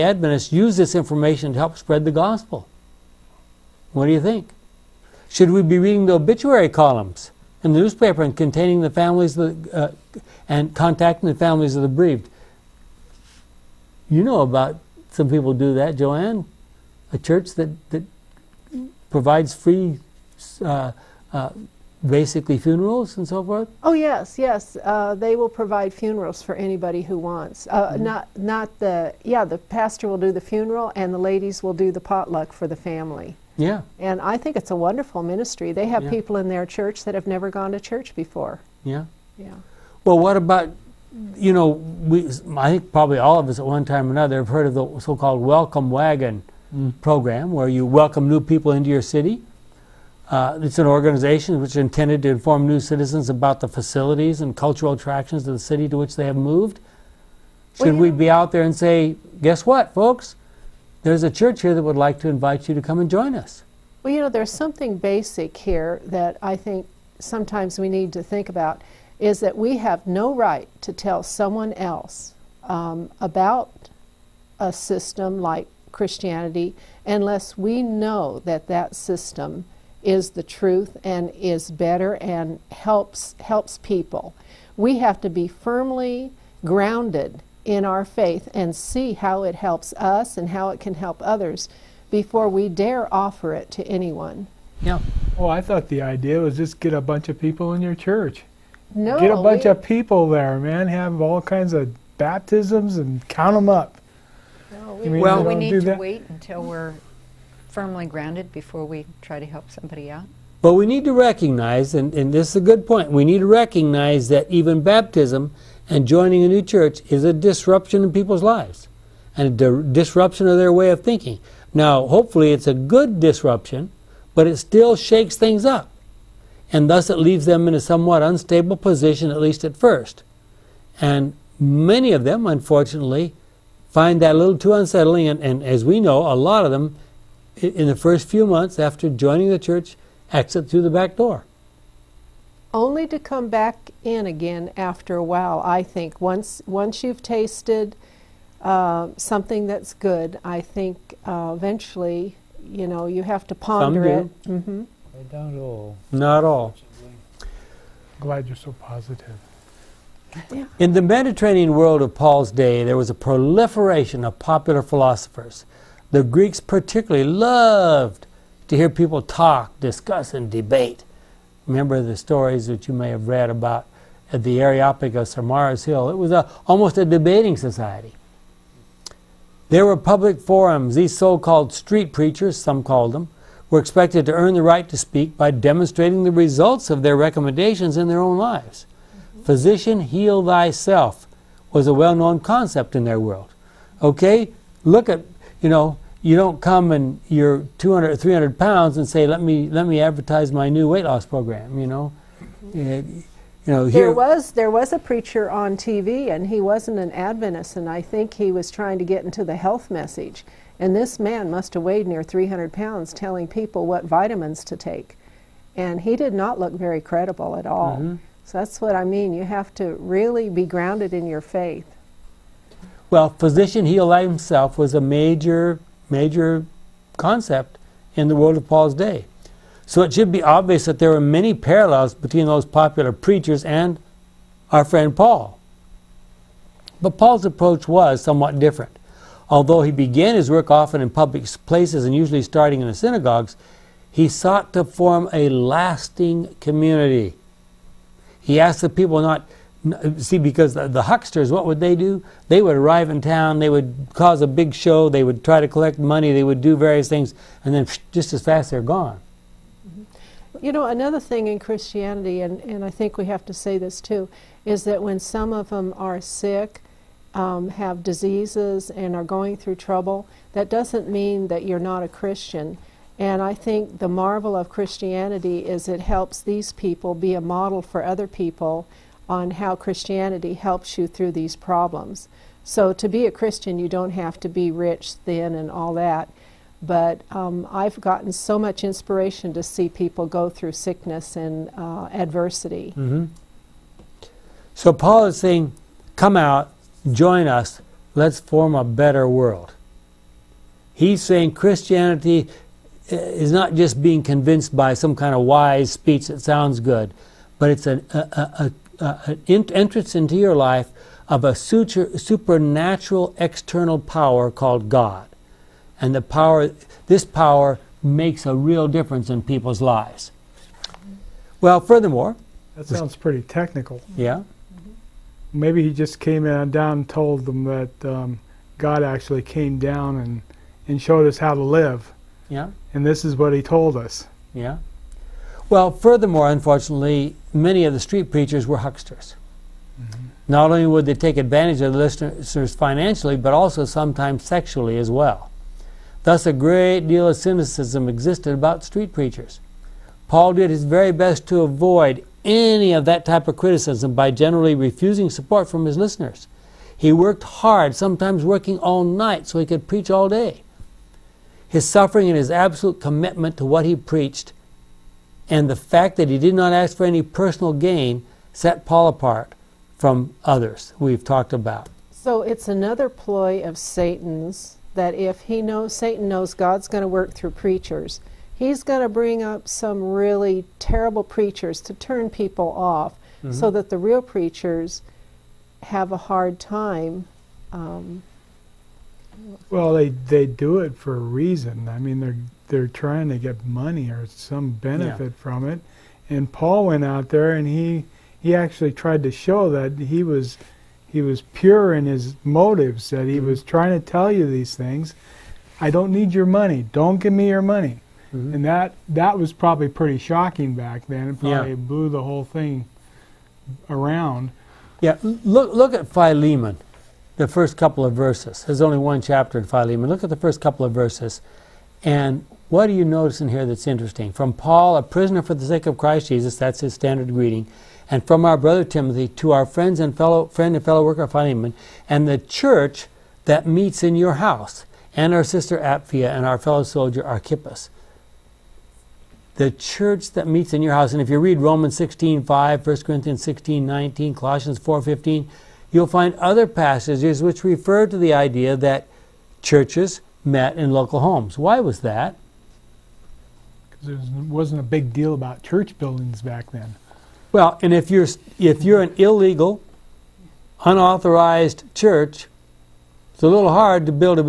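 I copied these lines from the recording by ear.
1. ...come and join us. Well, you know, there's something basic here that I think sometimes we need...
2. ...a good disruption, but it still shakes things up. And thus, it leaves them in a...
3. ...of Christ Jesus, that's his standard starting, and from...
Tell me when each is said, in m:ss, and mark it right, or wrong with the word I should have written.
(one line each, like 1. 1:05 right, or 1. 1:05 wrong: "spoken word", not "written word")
1. 1:02 right
2. 2:02 right
3. 7:05 wrong: "greeting", not "starting".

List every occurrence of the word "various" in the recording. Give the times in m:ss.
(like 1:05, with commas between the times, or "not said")
4:16.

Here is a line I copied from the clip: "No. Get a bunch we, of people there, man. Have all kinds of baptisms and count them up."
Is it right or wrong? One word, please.
right.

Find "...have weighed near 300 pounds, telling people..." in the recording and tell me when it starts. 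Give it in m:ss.
3:31.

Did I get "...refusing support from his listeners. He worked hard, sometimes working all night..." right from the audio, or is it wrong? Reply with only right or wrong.
right.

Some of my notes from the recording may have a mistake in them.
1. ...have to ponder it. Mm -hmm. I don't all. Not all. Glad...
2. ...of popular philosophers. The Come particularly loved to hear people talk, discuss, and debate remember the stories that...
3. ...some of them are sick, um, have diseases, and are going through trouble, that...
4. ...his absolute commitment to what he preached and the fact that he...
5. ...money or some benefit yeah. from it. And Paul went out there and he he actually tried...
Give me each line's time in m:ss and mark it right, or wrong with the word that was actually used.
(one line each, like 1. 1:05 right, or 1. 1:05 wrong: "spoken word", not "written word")
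1. 2:33 right
2. 2:44 wrong: "Greeks", not "Come"
3. 4:25 right
4. 6:02 right
5. 6:33 right.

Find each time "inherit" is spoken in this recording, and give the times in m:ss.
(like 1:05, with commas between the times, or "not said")
not said.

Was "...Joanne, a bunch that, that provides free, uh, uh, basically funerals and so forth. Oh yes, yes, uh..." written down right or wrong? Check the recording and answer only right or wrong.
wrong.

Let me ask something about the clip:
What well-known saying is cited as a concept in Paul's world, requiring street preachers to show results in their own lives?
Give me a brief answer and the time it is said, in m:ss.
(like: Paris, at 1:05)
Physician, heal thyself, at 3:09.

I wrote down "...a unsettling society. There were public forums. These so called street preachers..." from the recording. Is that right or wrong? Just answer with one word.
wrong.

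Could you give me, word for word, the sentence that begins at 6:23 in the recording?
so that the real preachers have a hard time.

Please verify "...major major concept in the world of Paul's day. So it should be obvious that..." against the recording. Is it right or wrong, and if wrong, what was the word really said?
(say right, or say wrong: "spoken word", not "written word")
right.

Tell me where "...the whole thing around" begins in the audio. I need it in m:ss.
6:52.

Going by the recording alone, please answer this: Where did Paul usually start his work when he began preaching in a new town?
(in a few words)
synagogues.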